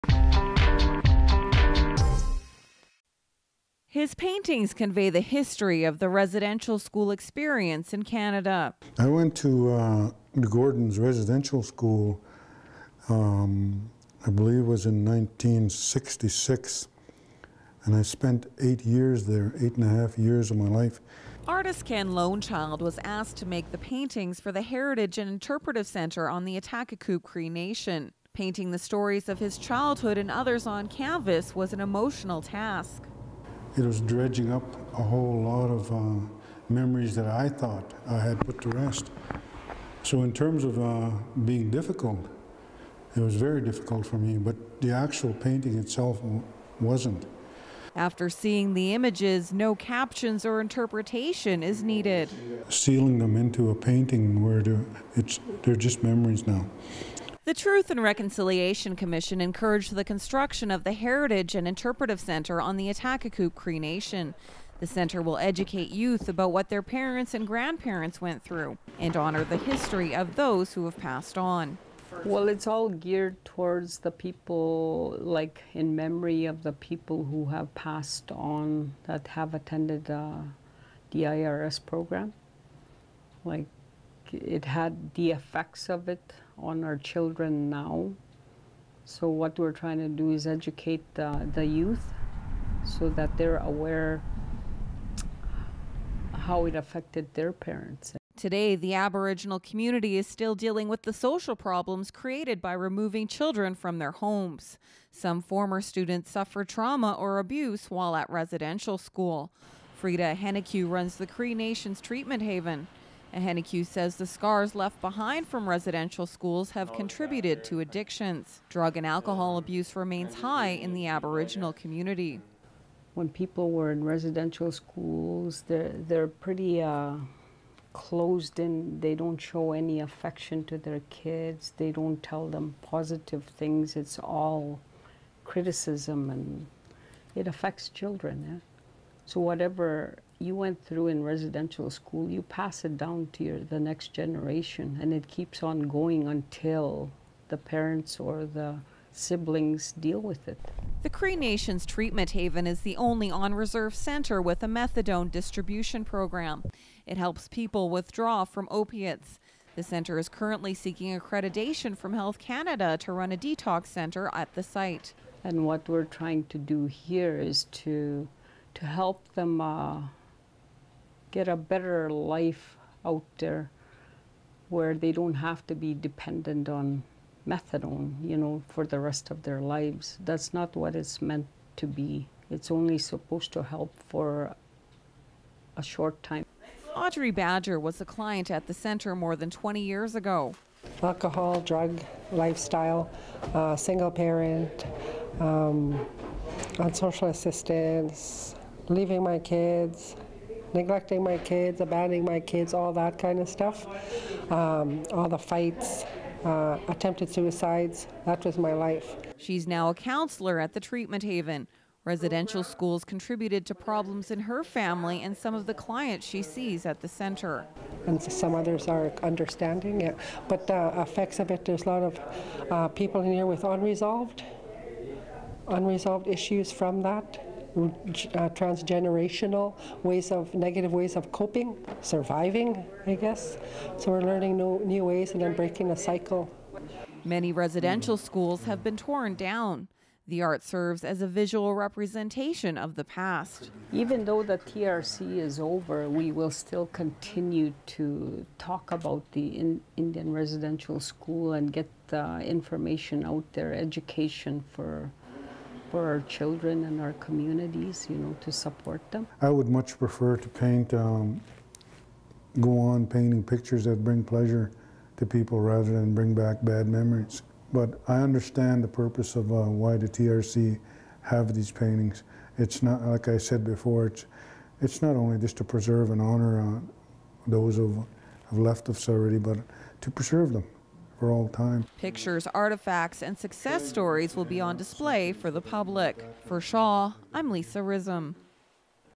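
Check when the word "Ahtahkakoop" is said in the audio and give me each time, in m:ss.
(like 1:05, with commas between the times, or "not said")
0:26, 1:02.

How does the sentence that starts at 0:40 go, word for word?
So in terms of uh, being difficult, it was very difficult for me, but the actual painting itself wasn't.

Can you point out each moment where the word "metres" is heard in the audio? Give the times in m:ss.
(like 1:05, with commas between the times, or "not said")
not said.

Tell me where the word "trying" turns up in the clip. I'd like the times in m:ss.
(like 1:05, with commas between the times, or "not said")
1:29, 2:46.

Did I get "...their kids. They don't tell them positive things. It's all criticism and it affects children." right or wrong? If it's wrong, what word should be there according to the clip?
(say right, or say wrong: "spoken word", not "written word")
right.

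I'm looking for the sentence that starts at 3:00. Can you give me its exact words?
That's not what it's meant to be.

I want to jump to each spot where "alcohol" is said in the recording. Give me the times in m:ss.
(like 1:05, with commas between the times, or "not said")
1:59, 3:11.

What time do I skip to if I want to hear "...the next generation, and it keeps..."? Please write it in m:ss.
2:23.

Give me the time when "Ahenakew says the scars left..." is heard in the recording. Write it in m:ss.
1:53.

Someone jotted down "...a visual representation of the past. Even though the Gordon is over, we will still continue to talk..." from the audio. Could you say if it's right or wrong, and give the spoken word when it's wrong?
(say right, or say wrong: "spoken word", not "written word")
wrong: "TRC", not "Gordon".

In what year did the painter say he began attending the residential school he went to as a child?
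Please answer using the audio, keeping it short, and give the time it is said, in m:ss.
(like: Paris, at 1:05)
1966, at 0:15.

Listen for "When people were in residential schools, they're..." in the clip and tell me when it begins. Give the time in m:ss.
2:03.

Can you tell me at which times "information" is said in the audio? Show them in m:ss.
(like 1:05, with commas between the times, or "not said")
4:12.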